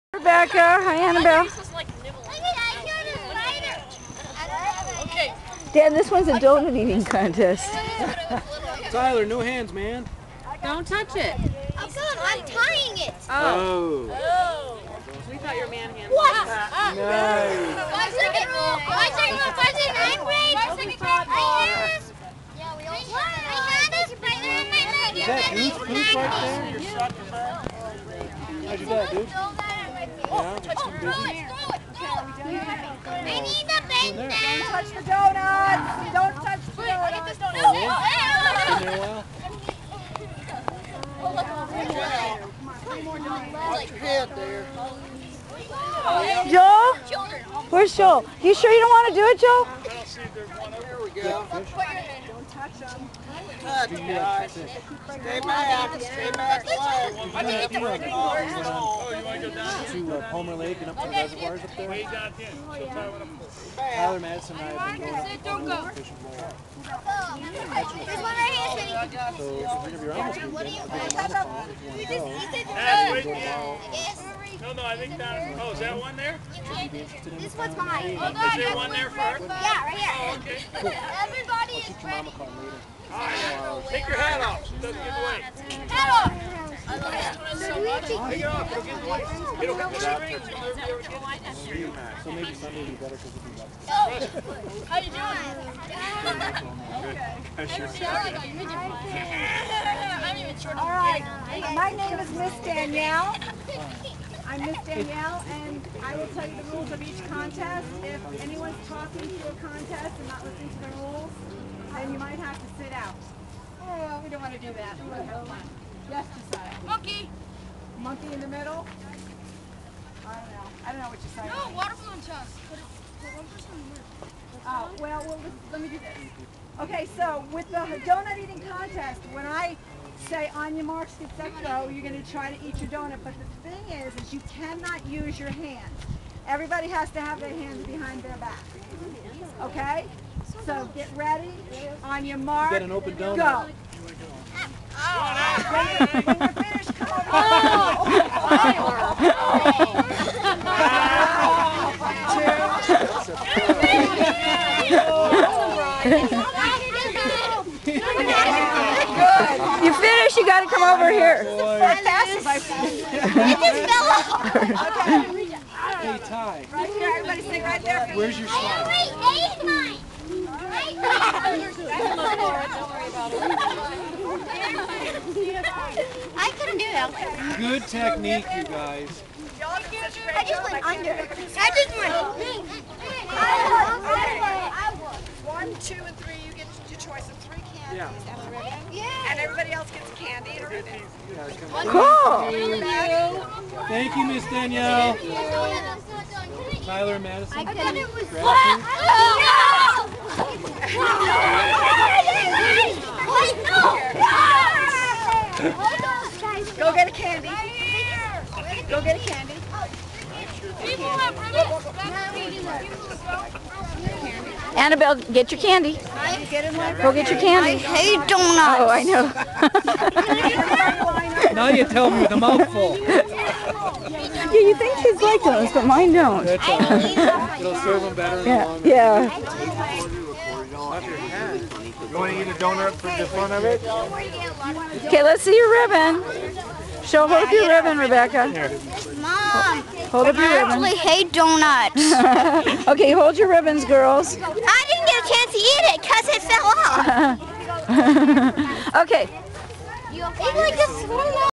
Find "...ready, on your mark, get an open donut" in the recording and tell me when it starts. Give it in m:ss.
2:21.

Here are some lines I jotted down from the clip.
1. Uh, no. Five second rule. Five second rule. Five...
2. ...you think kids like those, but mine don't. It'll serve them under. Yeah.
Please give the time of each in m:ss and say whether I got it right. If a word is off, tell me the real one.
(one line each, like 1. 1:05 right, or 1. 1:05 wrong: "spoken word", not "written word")
1. 0:16 right
2. 3:44 wrong: "better", not "under".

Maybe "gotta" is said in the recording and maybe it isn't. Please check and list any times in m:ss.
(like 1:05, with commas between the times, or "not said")
2:40.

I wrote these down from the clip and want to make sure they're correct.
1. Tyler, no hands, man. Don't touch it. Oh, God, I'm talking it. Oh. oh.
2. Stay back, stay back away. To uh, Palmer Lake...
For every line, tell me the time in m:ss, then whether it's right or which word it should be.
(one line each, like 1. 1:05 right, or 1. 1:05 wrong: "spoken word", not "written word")
1. 0:08 wrong: "tying", not "talking"
2. 0:54 right.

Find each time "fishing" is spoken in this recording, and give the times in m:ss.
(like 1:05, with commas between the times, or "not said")
1:05.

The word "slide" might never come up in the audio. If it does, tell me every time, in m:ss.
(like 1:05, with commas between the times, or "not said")
2:48.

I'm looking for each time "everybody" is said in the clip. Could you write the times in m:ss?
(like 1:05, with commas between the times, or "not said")
1:21, 2:16, 2:47, 3:09.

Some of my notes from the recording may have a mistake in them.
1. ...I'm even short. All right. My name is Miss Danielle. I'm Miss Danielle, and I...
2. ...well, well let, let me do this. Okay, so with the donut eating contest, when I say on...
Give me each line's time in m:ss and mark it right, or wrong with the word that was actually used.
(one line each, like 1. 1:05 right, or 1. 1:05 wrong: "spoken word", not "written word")
1. 1:40 right
2. 2:04 right.